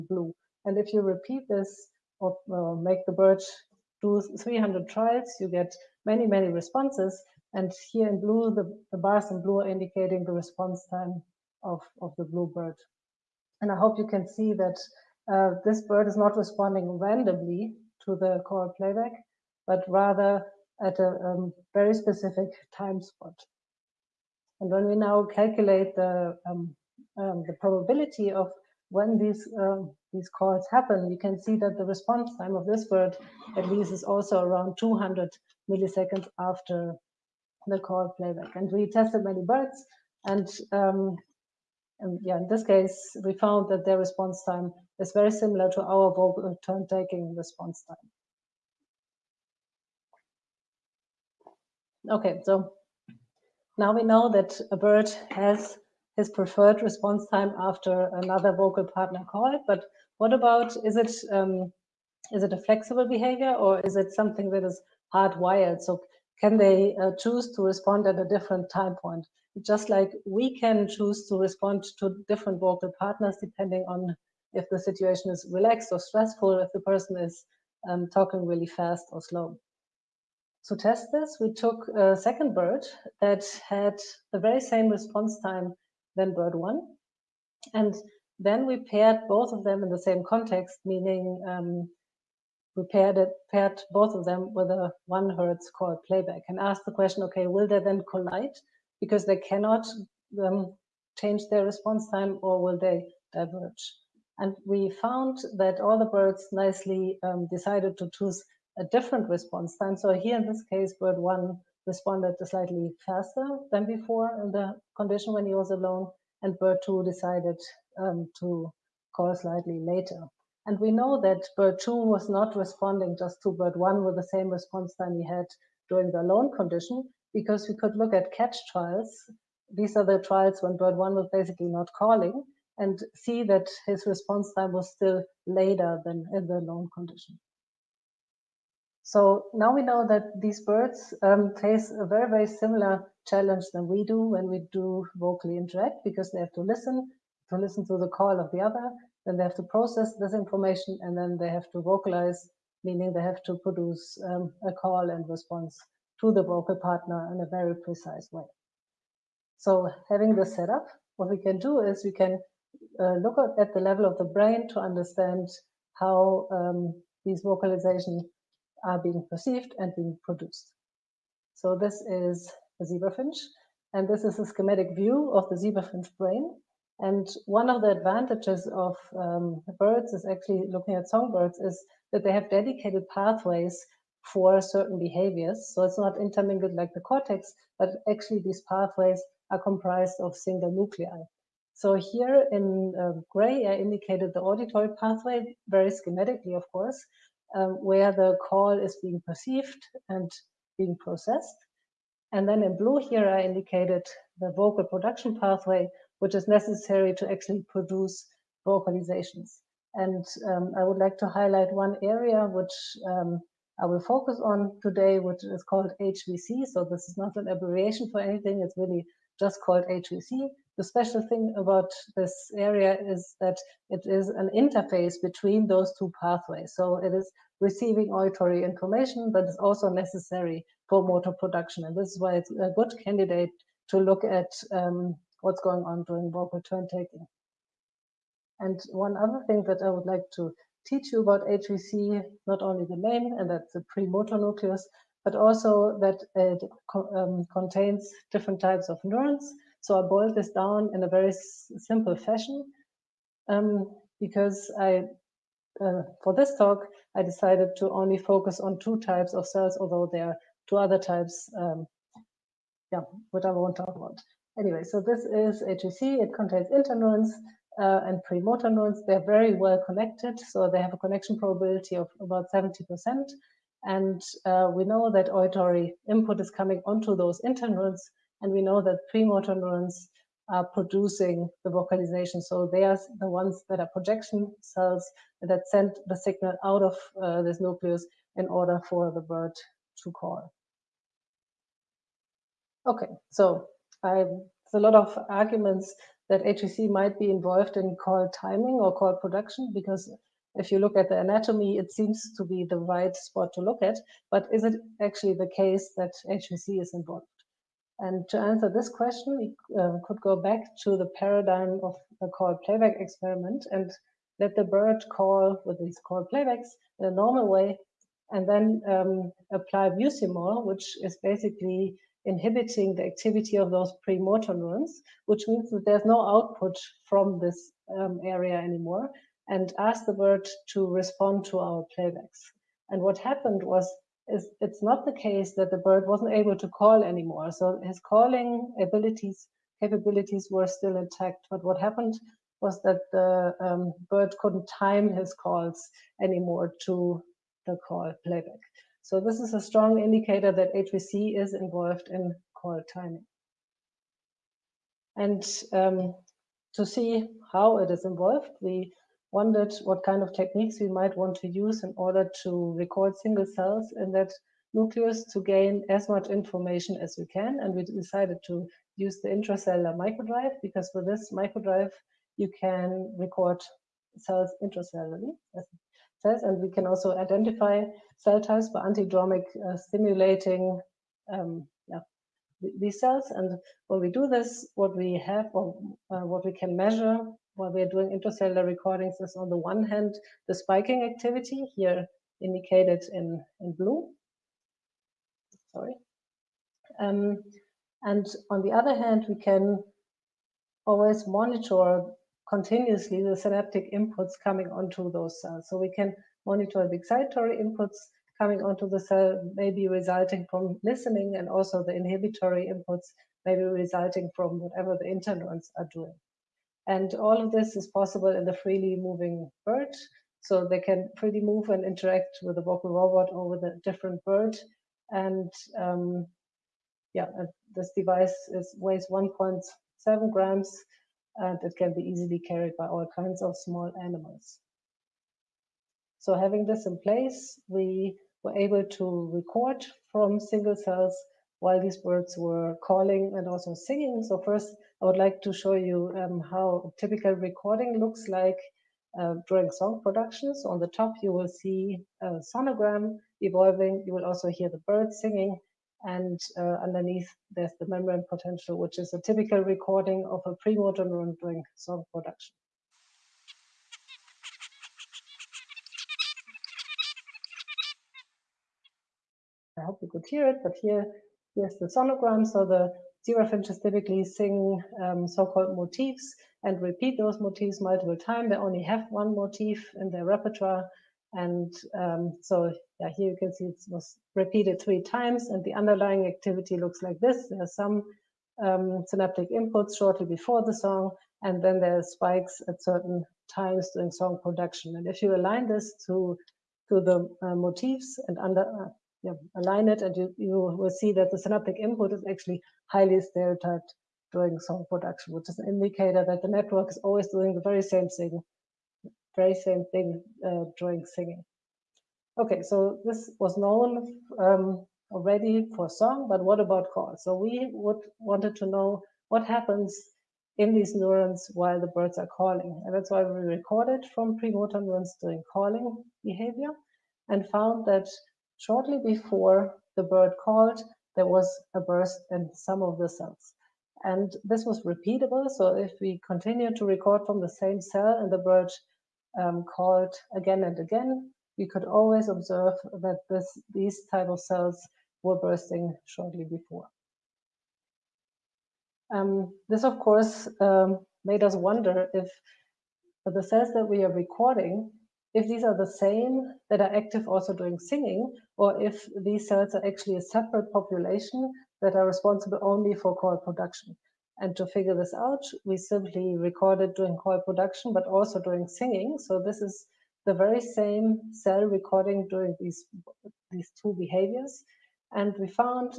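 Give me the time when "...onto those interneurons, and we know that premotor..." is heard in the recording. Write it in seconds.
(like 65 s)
276 s.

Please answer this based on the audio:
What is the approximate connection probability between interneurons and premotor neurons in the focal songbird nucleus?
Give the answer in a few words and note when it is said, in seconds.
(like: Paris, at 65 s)
70%, at 272 s.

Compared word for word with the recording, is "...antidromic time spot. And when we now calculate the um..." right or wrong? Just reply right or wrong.
wrong.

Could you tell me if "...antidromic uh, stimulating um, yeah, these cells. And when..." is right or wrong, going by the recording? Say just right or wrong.
right.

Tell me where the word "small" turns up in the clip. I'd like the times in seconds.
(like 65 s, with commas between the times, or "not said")
433 s.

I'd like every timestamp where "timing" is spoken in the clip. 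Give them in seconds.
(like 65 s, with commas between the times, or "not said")
298 s, 352 s.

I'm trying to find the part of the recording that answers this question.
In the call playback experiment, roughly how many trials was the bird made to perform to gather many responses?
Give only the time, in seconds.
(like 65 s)
4 s.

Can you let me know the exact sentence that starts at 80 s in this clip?
To test this, we took a second bird that had the very same response time than bird one.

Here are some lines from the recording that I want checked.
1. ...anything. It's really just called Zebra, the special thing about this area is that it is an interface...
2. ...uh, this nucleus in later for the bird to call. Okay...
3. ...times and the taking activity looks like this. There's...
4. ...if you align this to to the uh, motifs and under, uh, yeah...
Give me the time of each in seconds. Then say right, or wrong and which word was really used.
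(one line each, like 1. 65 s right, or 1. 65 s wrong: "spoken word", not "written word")
1. 218 s wrong: "HVC", not "Zebra"
2. 287 s wrong: "order", not "later"
3. 485 s wrong: "underlying", not "taking"
4. 495 s right.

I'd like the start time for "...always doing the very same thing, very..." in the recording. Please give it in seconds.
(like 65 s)
507 s.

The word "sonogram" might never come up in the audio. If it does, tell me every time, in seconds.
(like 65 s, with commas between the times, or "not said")
452 s, 471 s.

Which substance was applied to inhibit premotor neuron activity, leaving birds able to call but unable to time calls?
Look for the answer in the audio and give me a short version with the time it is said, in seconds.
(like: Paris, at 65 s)
Muscimol, at 319 s.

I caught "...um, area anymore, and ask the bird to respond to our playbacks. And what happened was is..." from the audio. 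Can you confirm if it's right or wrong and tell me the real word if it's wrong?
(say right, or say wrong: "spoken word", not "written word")
right.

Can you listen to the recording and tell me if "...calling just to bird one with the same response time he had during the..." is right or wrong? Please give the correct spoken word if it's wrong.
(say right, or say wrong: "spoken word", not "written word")
wrong: "responding", not "calling".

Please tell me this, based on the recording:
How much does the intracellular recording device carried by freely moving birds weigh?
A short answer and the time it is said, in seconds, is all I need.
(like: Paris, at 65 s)
1.7 grams, at 429 s.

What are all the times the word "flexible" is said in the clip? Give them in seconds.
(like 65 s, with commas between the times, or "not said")
62 s.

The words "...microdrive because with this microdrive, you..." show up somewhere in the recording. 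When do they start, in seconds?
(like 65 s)
369 s.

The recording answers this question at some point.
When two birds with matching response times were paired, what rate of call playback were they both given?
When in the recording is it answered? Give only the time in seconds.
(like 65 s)
95 s.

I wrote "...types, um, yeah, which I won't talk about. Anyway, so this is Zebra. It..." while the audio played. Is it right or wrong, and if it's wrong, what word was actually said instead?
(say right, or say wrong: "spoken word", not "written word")
wrong: "HVC", not "Zebra".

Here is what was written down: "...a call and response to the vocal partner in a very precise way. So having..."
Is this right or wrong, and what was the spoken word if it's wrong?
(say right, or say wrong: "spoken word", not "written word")
right.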